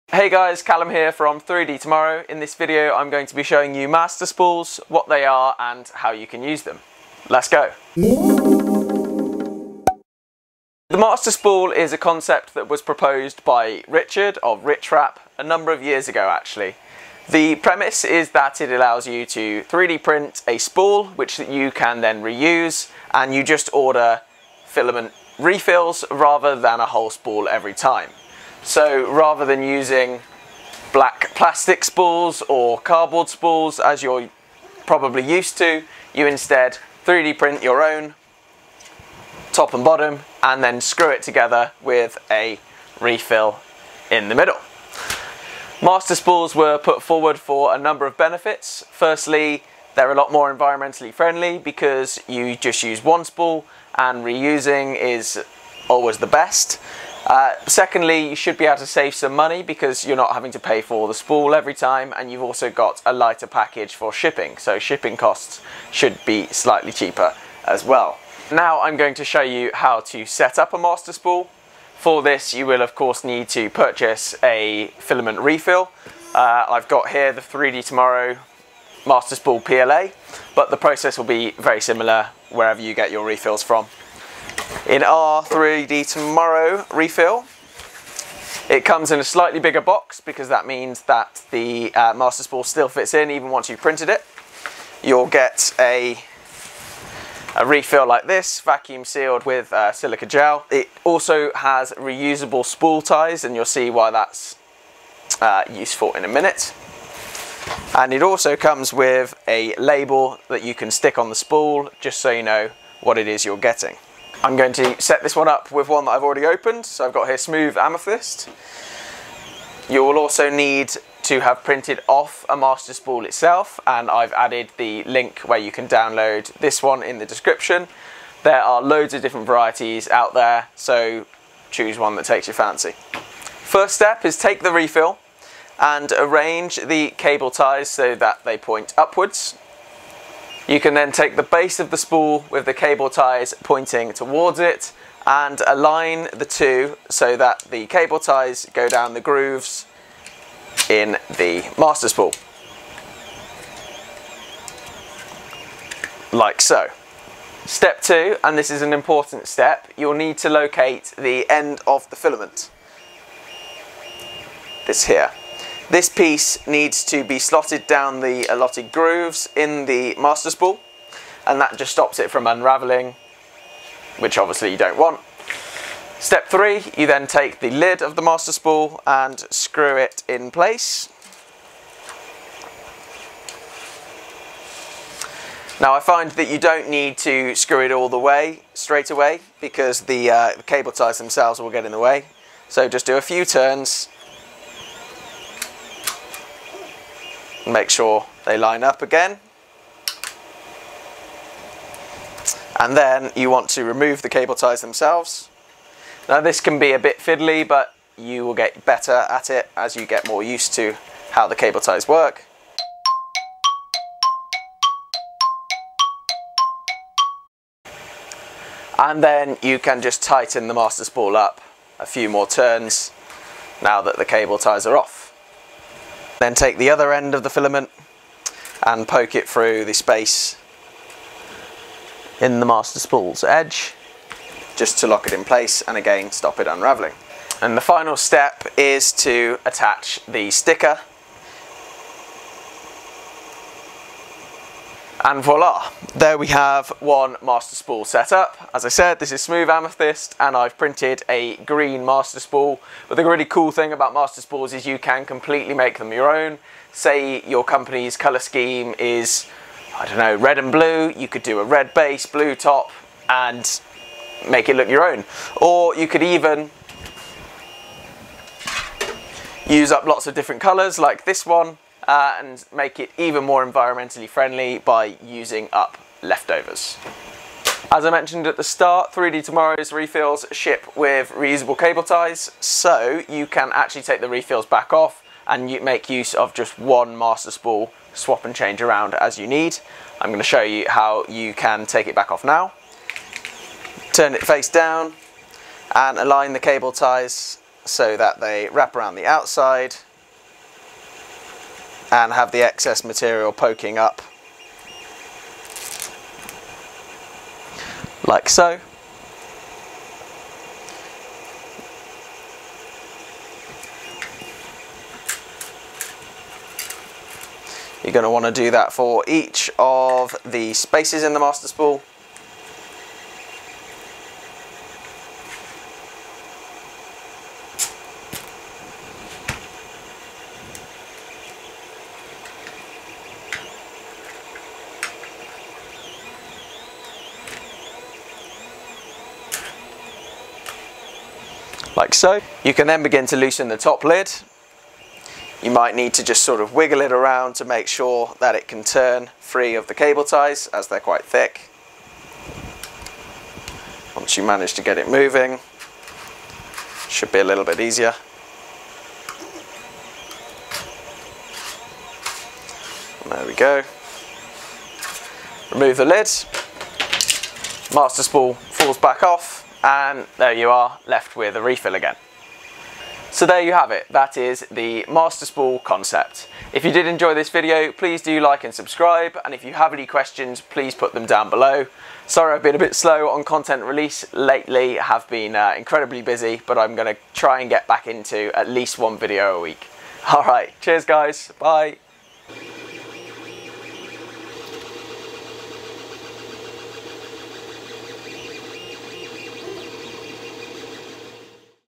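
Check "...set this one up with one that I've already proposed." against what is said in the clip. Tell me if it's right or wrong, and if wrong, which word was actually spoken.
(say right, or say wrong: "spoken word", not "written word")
wrong: "opened", not "proposed".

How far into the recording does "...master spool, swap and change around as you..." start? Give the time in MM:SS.
04:47.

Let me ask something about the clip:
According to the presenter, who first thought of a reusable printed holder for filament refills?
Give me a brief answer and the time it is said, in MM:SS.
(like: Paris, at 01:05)
Richard of Richrap, at 00:13.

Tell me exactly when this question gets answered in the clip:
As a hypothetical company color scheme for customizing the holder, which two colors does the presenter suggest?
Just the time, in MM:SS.
04:20.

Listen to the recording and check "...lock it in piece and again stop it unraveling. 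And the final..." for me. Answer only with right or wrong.
wrong.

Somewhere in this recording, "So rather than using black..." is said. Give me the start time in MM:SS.
00:28.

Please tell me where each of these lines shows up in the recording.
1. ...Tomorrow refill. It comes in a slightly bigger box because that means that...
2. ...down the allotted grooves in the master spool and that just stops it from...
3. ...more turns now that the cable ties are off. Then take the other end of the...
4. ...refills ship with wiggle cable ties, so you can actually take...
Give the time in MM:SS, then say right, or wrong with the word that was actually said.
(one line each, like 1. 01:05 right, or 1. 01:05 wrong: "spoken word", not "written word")
1. 01:26 right
2. 02:47 right
3. 03:42 right
4. 04:39 wrong: "reusable", not "wiggle".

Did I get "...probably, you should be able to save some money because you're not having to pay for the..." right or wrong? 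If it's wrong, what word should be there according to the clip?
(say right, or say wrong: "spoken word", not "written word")
wrong: "secondly", not "probably".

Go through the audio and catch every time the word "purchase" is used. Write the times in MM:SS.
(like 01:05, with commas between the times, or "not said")
01:13.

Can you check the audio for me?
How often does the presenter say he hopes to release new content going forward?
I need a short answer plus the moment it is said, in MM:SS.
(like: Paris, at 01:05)
At least one video a week, at 06:28.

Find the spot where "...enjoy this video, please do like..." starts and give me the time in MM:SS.
06:17.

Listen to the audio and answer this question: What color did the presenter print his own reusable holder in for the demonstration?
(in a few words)
Green.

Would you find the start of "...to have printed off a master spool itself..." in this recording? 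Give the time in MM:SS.
02:01.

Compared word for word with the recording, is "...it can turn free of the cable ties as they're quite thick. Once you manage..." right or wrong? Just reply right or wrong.
right.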